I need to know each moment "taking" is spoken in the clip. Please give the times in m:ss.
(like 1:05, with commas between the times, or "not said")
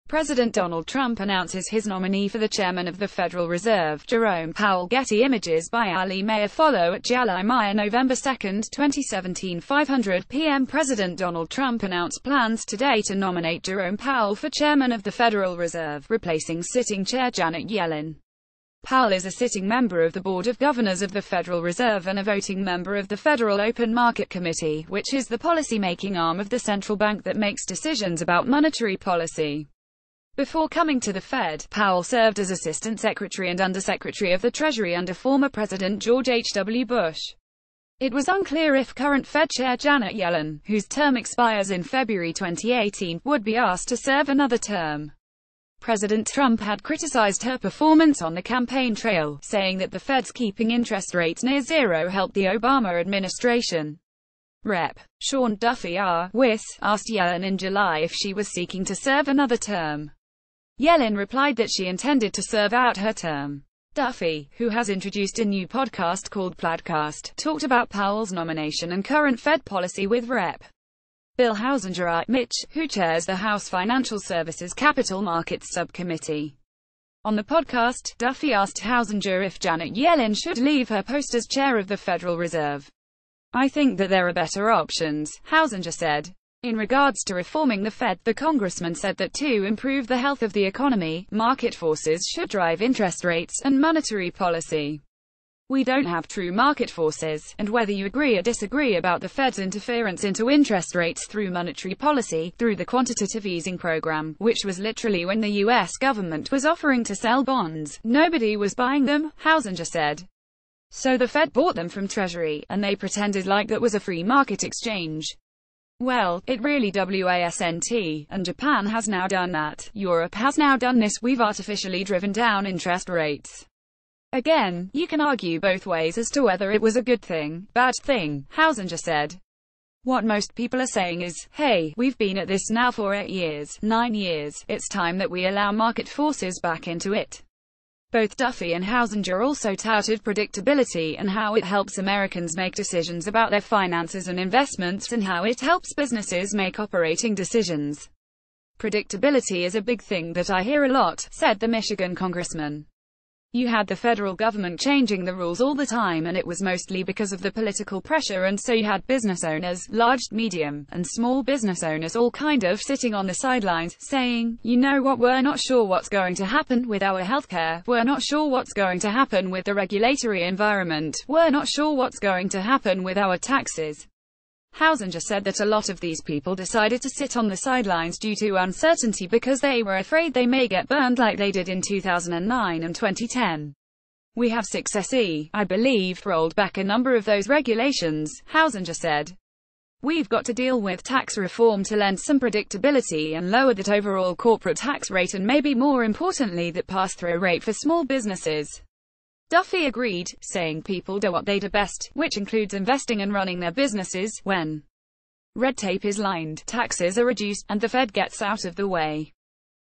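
not said.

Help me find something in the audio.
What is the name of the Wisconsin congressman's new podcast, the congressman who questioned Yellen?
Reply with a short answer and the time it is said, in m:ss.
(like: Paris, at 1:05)
Plaidcast, at 1:06.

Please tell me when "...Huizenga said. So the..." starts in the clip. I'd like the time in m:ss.
1:49.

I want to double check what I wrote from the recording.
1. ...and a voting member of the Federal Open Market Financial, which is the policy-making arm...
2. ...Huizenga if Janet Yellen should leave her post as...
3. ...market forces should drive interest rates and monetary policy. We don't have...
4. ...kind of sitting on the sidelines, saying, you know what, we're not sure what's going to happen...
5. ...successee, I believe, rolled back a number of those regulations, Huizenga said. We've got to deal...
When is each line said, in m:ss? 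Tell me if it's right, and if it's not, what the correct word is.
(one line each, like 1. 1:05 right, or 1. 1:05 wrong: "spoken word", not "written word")
1. 0:22 wrong: "Committee", not "Financial"
2. 1:18 right
3. 1:31 right
4. 2:42 right
5. 3:04 right.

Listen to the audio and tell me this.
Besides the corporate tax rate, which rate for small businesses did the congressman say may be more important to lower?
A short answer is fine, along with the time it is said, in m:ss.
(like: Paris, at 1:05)
pass-through rate, at 3:16.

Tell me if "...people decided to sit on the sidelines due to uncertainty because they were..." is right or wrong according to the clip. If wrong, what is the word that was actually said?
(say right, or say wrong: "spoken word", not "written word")
right.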